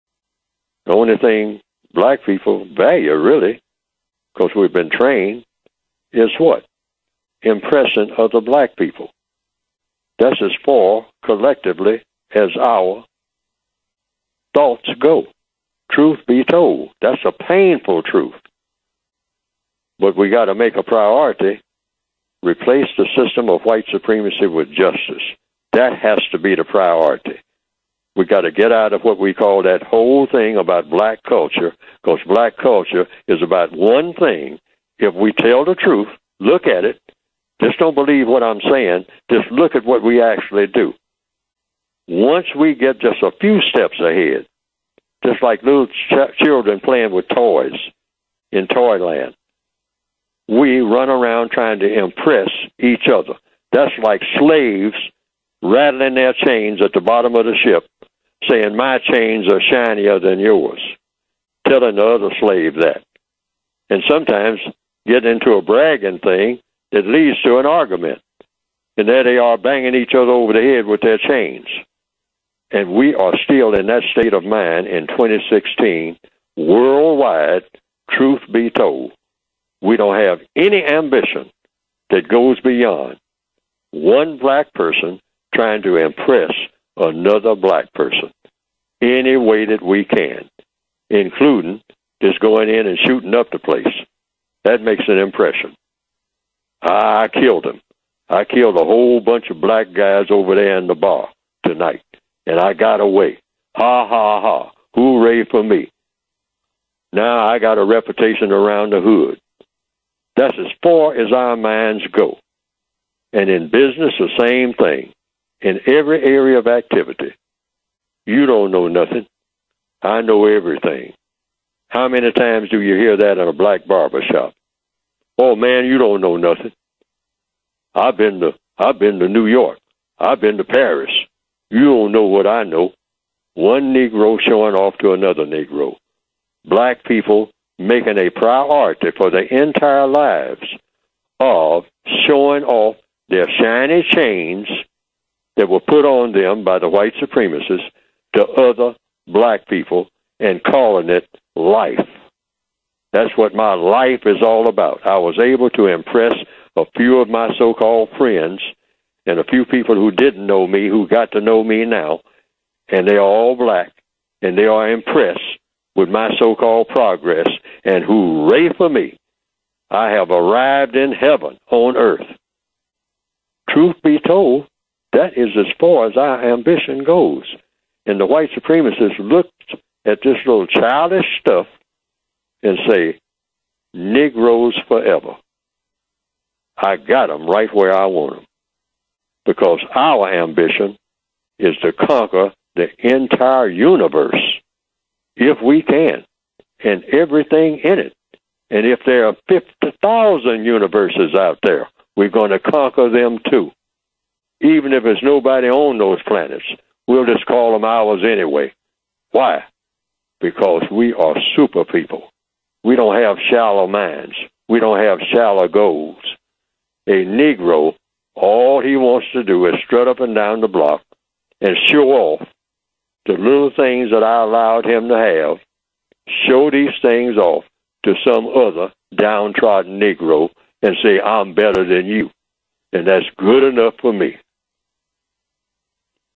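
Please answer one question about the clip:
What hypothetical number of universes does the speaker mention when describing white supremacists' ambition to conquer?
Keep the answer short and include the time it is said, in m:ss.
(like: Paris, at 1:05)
50,000, at 3:19.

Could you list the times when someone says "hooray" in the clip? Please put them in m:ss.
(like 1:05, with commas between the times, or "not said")
1:44, 2:48.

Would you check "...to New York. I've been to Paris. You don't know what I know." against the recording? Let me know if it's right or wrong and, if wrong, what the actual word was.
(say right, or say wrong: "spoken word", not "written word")
right.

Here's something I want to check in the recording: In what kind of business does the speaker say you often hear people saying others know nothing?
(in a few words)
Black barber shop.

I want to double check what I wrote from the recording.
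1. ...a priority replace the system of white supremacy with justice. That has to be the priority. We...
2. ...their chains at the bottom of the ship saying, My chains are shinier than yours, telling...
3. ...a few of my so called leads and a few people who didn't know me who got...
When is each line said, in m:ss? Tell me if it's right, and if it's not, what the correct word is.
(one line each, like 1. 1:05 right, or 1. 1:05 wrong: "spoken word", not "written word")
1. 0:20 right
2. 0:56 right
3. 2:36 wrong: "friends", not "leads".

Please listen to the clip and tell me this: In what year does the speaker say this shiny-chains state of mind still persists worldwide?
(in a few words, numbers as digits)
2016.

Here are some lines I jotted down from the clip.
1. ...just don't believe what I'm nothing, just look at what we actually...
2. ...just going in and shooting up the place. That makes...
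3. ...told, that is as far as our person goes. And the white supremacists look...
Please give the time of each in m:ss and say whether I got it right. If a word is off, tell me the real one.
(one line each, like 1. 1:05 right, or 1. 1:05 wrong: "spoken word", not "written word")
1. 0:37 wrong: "saying", not "nothing"
2. 1:32 right
3. 2:54 wrong: "ambition", not "person".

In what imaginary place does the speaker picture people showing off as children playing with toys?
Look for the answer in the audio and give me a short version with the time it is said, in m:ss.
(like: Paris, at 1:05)
Toyland, at 0:48.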